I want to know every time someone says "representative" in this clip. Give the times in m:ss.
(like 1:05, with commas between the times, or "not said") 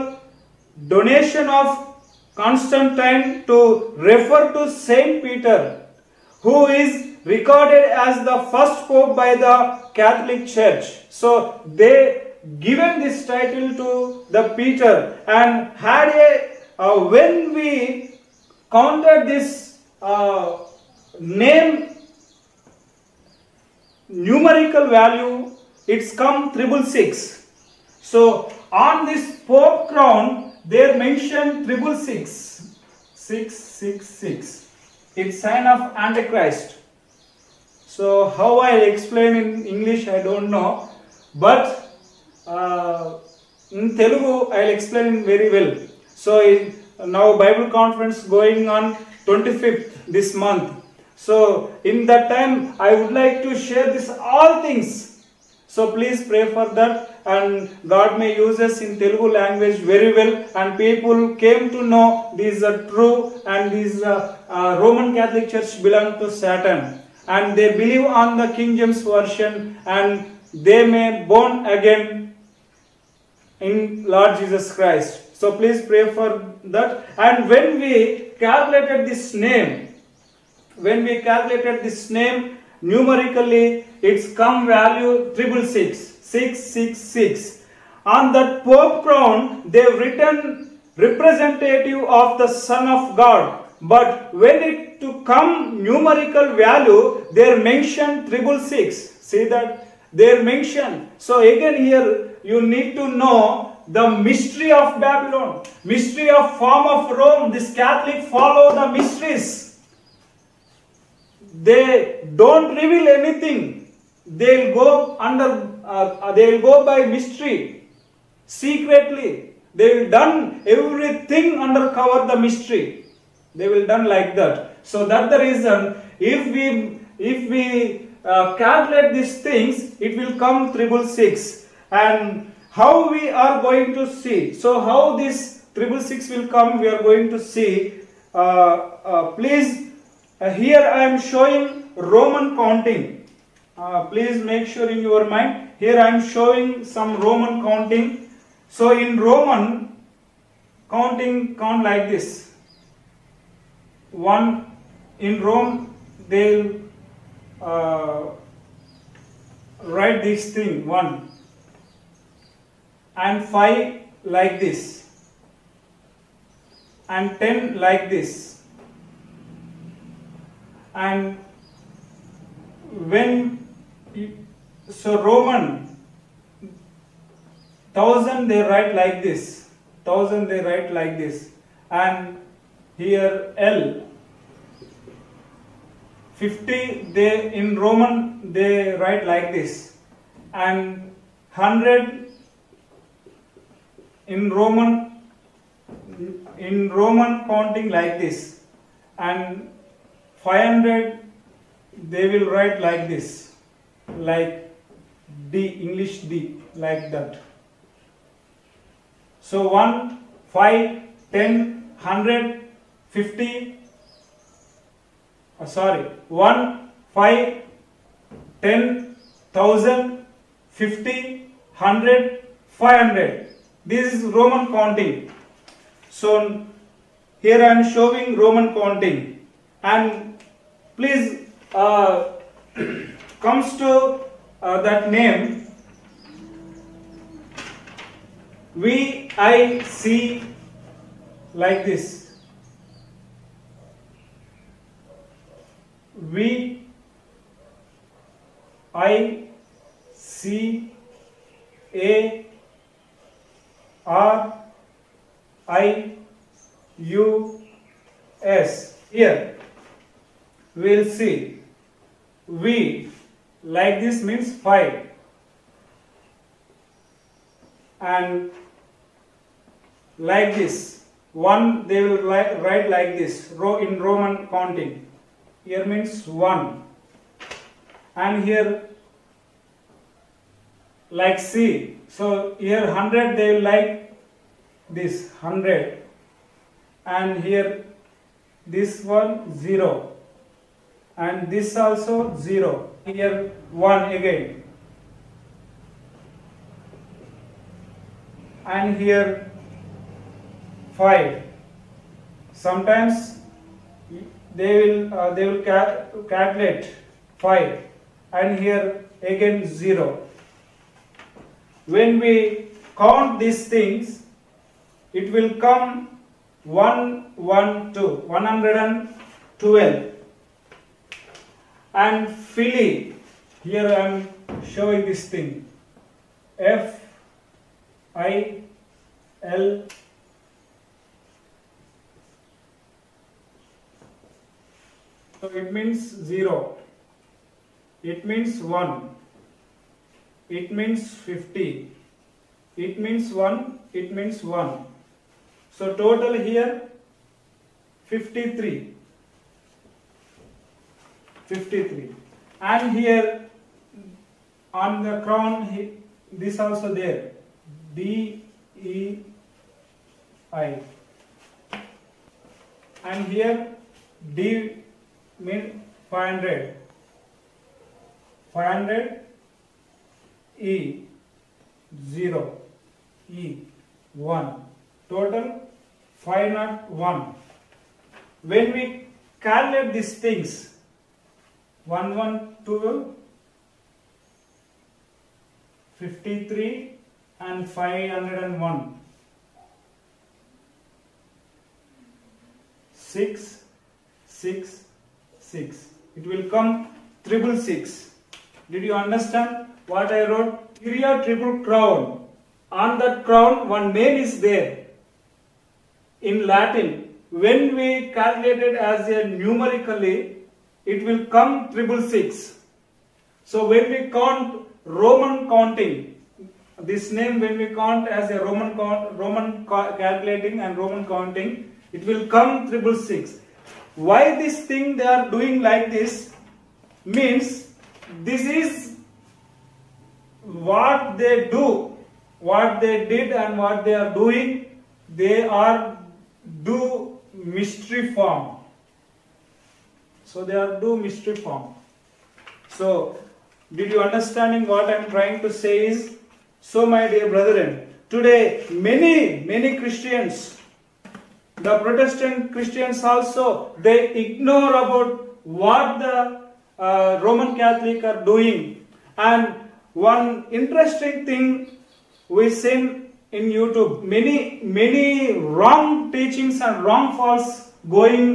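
1:30.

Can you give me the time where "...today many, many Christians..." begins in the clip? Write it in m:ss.
7:28.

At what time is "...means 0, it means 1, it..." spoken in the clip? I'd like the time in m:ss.
5:35.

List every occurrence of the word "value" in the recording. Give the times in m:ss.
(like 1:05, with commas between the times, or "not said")
0:24, 1:24, 1:36.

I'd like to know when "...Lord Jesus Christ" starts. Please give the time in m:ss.
1:14.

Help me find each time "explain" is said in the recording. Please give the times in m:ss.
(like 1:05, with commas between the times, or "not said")
0:38, 0:44.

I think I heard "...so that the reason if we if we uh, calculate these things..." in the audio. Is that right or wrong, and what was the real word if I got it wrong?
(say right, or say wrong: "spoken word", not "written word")
right.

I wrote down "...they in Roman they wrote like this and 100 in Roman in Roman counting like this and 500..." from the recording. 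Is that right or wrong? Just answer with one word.
wrong.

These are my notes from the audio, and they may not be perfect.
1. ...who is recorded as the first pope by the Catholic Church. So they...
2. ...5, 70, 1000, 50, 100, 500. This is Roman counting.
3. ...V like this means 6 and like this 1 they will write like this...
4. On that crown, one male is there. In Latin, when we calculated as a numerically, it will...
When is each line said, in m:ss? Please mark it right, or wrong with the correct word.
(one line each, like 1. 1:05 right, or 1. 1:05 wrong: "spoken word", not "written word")
1. 0:06 right
2. 3:37 wrong: "10", not "70"
3. 4:22 wrong: "5", not "6"
4. 6:42 right.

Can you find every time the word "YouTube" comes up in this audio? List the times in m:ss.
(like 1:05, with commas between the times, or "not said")
7:43.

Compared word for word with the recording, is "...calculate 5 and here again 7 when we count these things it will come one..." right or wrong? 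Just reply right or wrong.
wrong.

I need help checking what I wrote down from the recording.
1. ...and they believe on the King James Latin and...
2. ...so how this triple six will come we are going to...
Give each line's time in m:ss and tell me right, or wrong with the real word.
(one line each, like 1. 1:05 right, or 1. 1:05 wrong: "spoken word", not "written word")
1. 1:07 wrong: "Version", not "Latin"
2. 2:14 right.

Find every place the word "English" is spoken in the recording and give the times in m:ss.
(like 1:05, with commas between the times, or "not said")
0:39, 3:25.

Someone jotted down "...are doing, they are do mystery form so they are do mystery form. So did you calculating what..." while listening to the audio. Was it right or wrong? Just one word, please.
wrong.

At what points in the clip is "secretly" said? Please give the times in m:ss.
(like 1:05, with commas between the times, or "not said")
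1:58.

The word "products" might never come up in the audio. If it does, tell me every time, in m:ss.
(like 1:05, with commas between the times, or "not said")
not said.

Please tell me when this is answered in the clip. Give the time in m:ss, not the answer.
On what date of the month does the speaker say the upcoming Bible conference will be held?
0:49.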